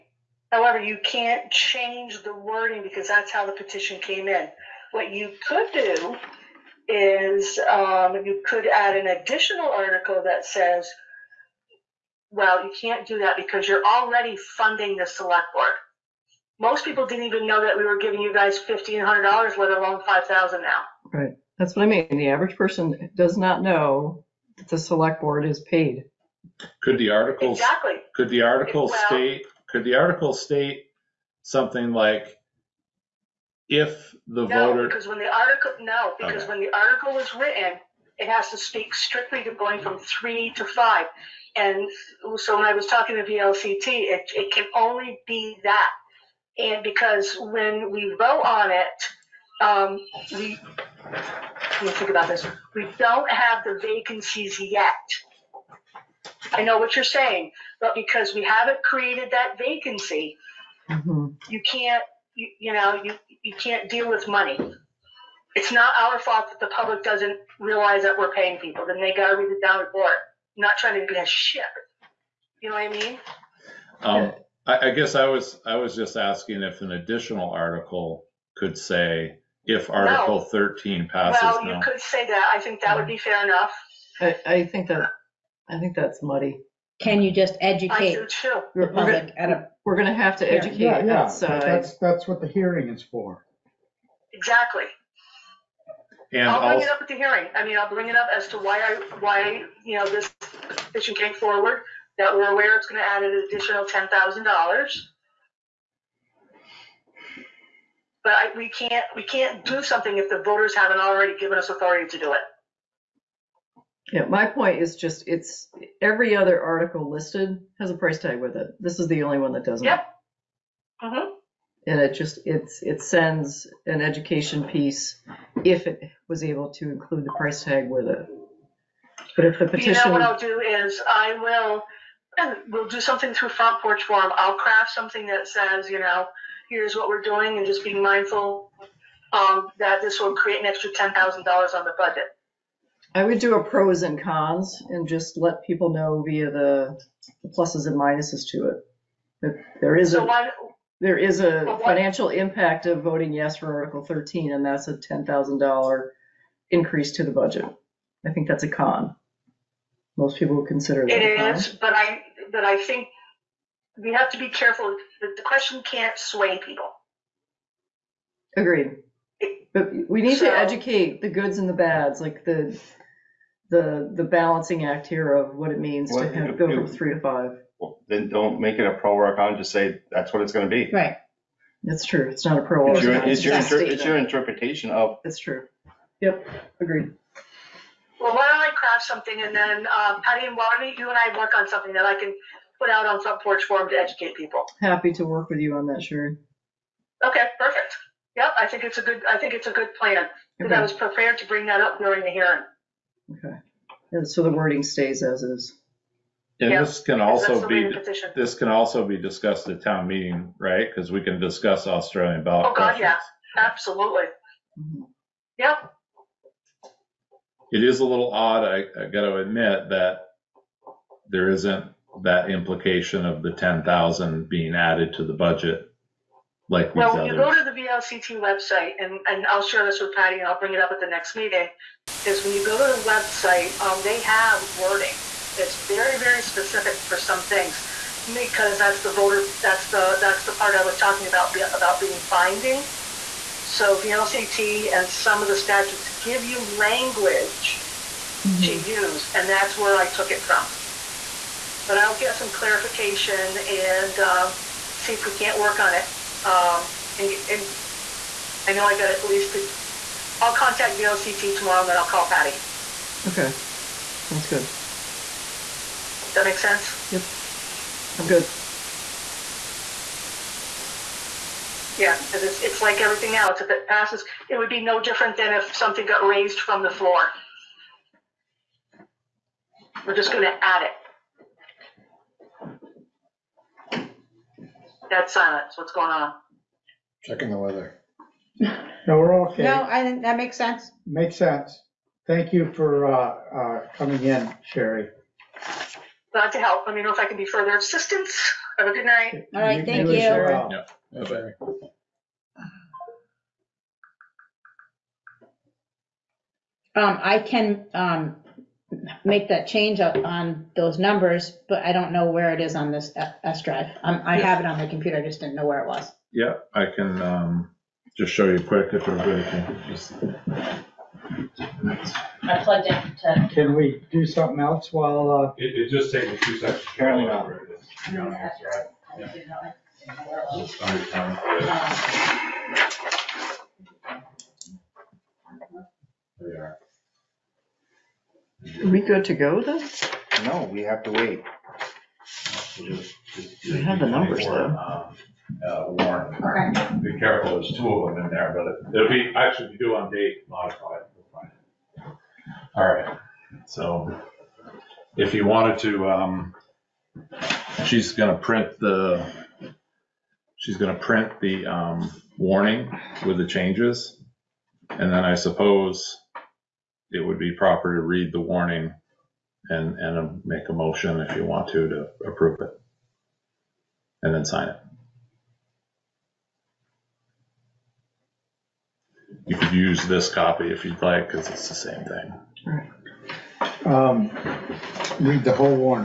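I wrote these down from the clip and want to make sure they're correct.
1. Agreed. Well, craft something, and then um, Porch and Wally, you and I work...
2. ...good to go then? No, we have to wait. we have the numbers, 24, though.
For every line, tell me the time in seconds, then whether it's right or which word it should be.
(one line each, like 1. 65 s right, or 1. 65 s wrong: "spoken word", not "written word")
1. 186 s wrong: "Patty", not "Porch"
2. 339 s right.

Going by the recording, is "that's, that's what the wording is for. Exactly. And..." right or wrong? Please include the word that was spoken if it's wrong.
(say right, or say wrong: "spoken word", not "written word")
wrong: "hearing", not "wording".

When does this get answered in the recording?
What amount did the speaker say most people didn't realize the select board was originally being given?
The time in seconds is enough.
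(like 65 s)
18 s.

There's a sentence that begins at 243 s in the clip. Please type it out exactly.
So VLCT and some of the statutes give you language mm-hmm.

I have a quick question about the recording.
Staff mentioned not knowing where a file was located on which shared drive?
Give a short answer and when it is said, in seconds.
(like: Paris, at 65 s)
S drive, at 313 s.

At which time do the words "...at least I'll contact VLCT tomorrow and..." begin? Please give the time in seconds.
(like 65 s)
259 s.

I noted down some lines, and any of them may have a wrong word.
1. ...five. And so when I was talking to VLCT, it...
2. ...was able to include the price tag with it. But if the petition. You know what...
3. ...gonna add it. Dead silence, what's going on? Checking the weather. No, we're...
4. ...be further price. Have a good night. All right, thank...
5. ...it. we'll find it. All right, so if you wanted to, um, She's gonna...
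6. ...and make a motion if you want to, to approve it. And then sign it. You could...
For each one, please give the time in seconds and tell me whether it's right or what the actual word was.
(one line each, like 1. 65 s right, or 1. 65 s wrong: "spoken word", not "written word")
1. 40 s right
2. 126 s right
3. 280 s right
4. 297 s wrong: "assistance", not "price"
5. 350 s right
6. 369 s right.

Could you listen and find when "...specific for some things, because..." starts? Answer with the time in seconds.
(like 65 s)
236 s.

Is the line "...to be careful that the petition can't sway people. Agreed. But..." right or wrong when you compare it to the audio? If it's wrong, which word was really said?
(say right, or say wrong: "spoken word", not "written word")
wrong: "question", not "petition".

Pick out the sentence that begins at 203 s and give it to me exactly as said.
Okay, and so the wording stays as is.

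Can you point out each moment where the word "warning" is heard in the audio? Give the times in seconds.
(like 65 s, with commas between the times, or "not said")
362 s, 368 s.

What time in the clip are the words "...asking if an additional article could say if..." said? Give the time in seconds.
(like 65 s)
76 s.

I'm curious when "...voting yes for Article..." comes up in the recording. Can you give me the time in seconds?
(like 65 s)
153 s.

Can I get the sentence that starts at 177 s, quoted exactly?
Well, then don't make it a pro or a con.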